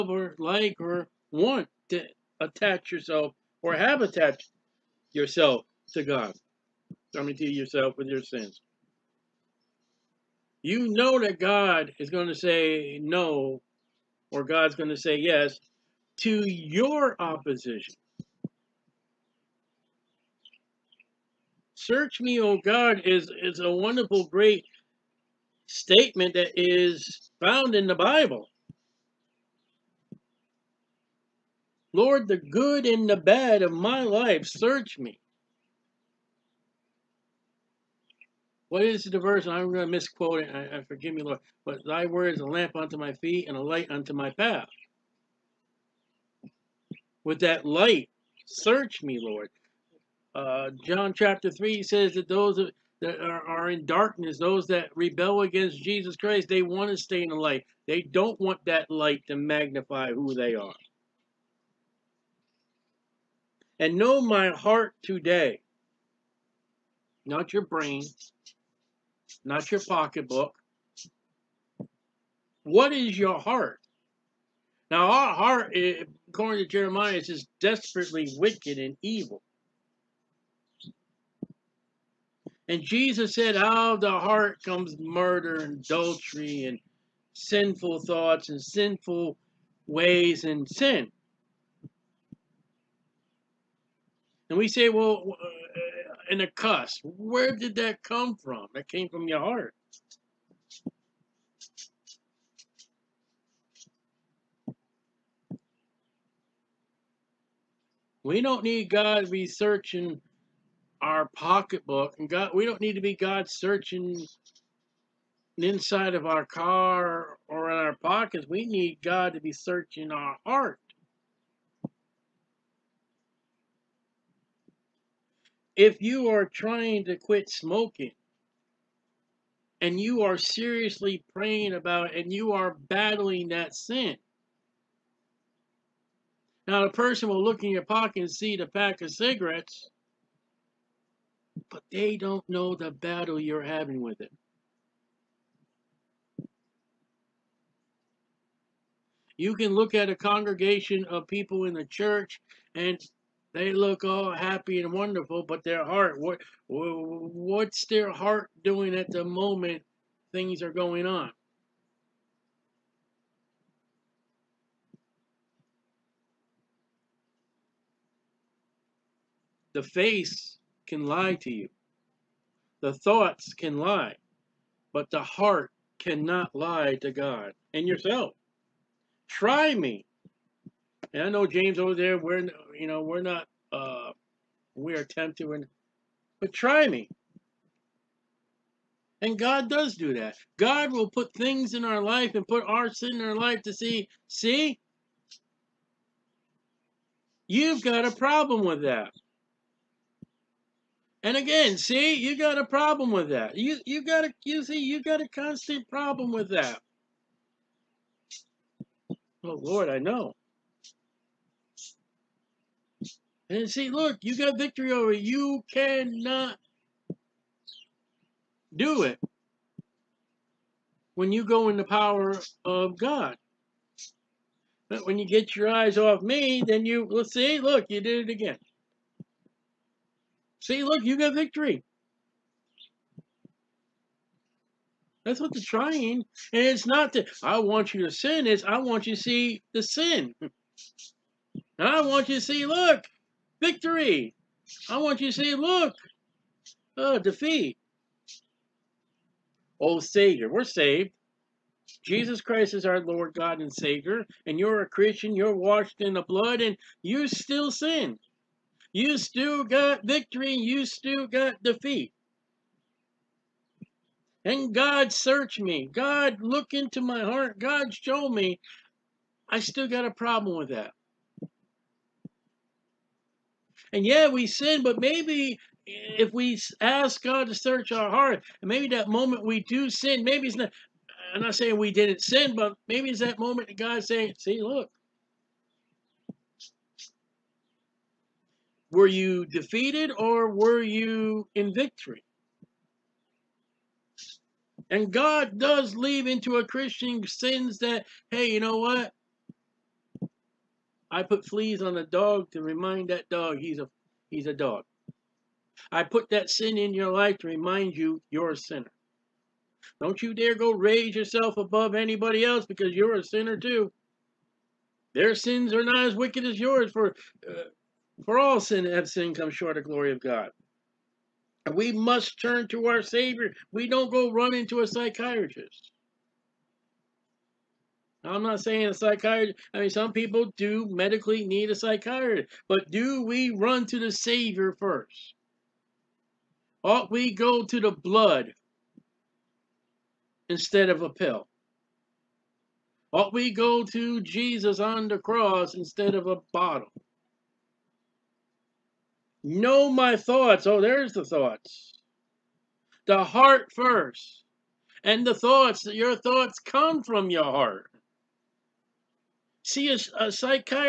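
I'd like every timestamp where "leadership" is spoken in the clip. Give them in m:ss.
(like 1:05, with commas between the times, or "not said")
not said.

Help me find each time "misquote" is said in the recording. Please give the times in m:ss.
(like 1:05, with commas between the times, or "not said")
0:39.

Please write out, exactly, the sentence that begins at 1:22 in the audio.
And Jesus said, out of the heart comes murder and adultery and sinful thoughts and sinful ways and sin.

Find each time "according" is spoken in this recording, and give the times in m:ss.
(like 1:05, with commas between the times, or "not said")
1:16.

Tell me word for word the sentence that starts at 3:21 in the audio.
And again, see, you got a problem with that.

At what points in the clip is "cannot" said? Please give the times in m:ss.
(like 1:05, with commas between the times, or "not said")
2:55, 3:35.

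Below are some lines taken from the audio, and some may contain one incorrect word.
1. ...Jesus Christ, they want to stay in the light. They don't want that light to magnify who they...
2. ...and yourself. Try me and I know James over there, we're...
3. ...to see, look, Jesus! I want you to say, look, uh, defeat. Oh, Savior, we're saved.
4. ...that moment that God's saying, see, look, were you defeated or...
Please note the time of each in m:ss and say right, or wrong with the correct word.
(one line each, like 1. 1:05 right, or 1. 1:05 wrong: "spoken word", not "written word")
1. 0:55 right
2. 2:57 right
3. 4:02 wrong: "Victory", not "Jesus"
4. 4:43 right.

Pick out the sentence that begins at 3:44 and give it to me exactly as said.
But when you get your eyes off me, then you, well, see, look, you did it again.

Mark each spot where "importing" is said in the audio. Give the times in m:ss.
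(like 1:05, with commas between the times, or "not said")
not said.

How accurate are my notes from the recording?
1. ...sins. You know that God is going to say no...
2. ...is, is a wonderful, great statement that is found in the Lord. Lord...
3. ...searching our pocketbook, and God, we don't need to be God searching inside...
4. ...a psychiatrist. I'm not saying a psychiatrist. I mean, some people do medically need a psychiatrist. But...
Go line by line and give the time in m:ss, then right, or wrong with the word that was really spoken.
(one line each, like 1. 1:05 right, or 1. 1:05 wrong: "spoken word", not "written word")
1. 0:08 right
2. 0:23 wrong: "Bible", not "Lord"
3. 1:49 right
4. 5:24 right.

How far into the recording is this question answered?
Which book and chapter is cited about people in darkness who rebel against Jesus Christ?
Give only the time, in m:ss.
0:50.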